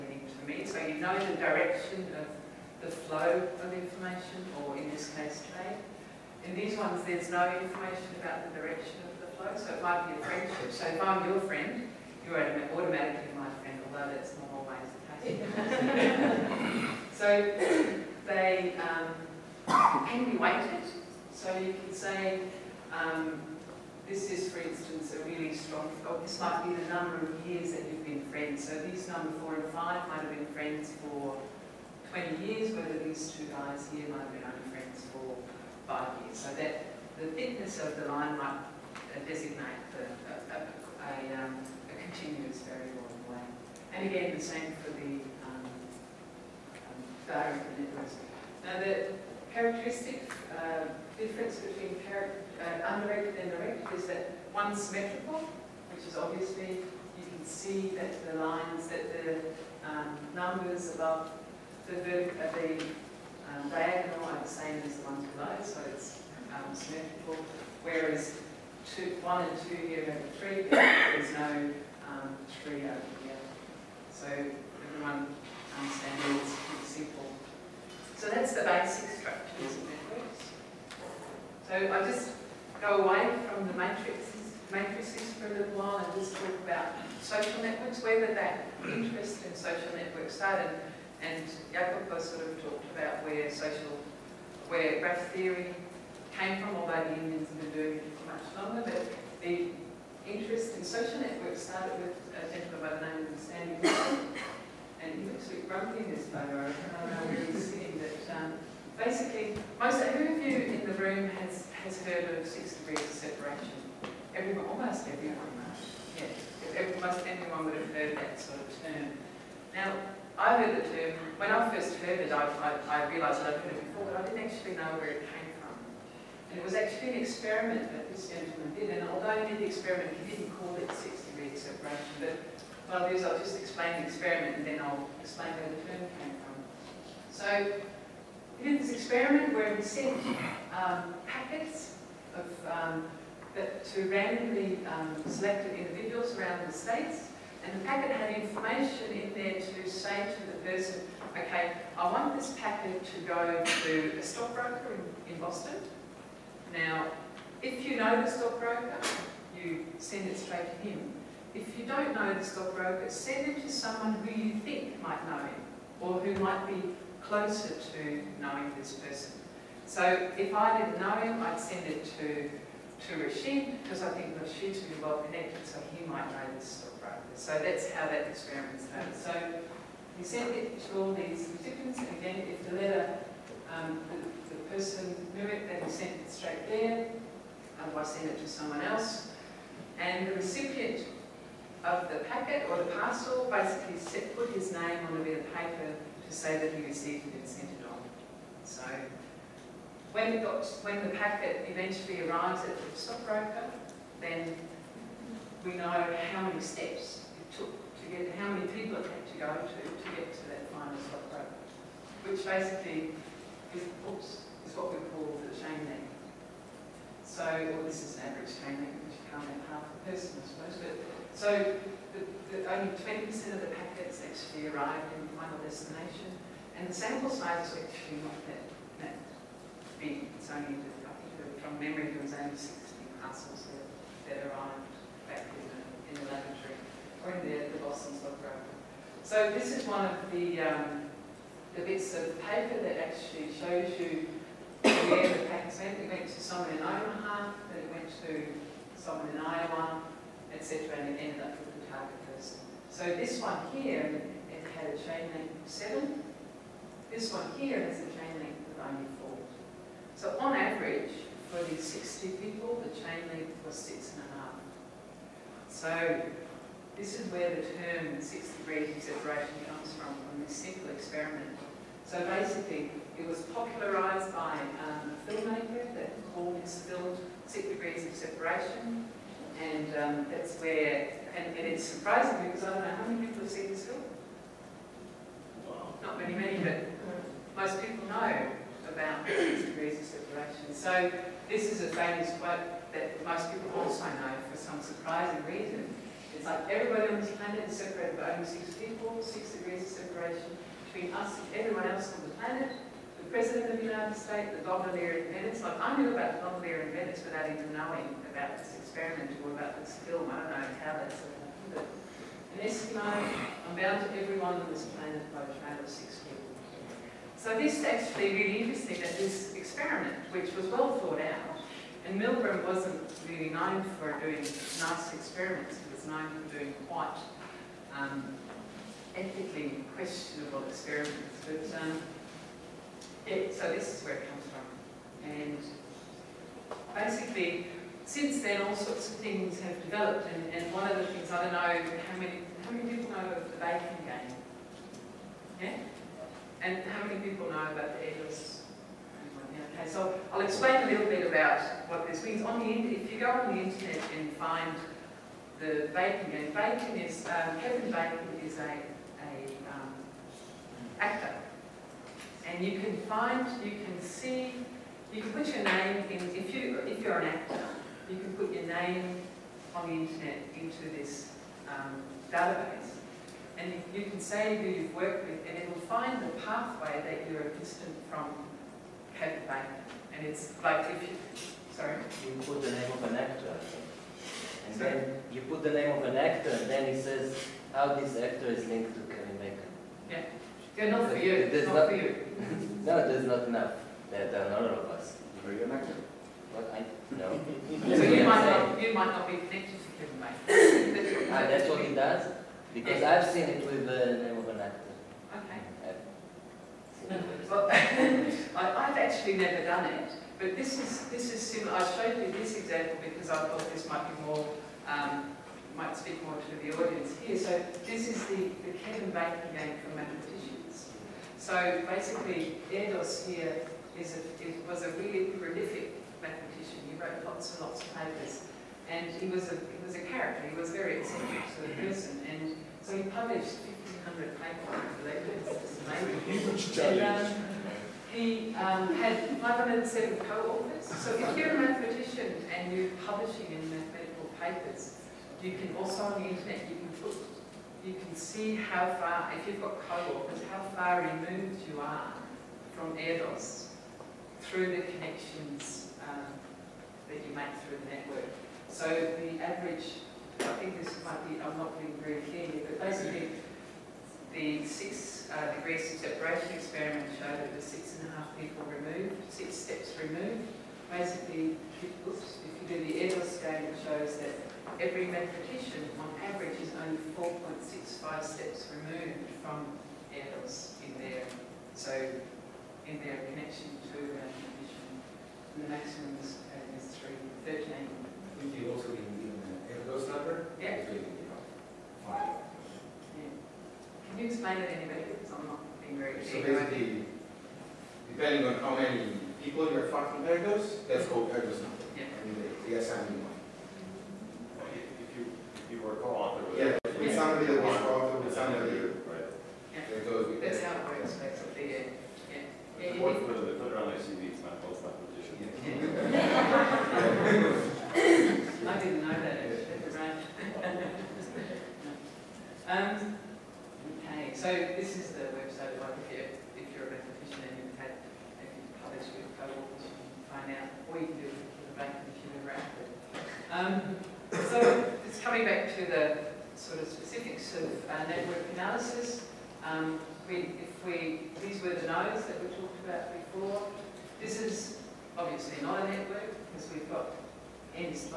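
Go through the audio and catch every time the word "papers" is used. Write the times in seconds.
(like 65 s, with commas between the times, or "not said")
195 s, 242 s, 427 s, 434 s, 444 s.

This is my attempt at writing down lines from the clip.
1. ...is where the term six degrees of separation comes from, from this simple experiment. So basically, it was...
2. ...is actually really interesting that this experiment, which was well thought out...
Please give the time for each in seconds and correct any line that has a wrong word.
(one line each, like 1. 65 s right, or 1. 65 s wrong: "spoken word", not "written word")
1. 267 s right
2. 317 s right.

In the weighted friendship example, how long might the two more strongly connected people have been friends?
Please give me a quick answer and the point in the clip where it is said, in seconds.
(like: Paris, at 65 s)
20 years, at 32 s.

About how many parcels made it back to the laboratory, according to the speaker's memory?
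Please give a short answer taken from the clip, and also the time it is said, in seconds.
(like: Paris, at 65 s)
60, at 232 s.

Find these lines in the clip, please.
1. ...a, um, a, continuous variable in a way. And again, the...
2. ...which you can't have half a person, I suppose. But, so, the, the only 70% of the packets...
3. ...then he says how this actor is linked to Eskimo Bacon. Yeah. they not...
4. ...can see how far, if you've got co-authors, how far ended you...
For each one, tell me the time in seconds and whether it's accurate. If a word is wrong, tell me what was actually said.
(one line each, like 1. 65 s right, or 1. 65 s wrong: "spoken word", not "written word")
1. 40 s right
2. 219 s wrong: "20", not "70"
3. 386 s wrong: "Kevin", not "Eskimo"
4. 447 s wrong: "removed", not "ended".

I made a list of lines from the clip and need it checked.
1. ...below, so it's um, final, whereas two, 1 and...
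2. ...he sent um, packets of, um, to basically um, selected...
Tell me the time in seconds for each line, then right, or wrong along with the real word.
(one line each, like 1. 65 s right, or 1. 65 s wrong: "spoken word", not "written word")
1. 65 s wrong: "symmetrical", not "final"
2. 139 s wrong: "randomly", not "basically".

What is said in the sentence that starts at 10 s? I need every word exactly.
So if I'm your friend, you're automatically my friend, although that's not always the case.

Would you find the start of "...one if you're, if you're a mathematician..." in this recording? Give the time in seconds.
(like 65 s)
525 s.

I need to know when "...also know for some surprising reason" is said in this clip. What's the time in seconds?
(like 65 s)
293 s.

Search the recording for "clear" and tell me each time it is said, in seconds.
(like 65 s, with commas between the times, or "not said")
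462 s, 496 s.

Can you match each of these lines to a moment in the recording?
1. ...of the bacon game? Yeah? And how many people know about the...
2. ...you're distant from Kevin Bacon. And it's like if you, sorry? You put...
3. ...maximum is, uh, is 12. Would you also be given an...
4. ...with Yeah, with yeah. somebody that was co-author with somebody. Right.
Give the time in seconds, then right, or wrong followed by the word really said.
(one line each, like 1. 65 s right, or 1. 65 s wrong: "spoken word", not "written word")
1. 343 s right
2. 377 s right
3. 485 s wrong: "13", not "12"
4. 506 s right.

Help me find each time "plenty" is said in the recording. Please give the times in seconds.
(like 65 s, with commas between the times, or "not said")
not said.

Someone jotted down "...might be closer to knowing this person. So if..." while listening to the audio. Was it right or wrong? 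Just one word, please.
right.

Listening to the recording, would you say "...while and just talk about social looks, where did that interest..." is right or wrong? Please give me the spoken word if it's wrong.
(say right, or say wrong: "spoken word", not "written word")
wrong: "networks", not "looks".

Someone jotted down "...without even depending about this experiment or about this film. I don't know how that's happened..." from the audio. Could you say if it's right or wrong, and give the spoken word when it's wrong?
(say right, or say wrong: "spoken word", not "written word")
wrong: "knowing", not "depending".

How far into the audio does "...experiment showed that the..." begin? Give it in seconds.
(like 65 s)
466 s.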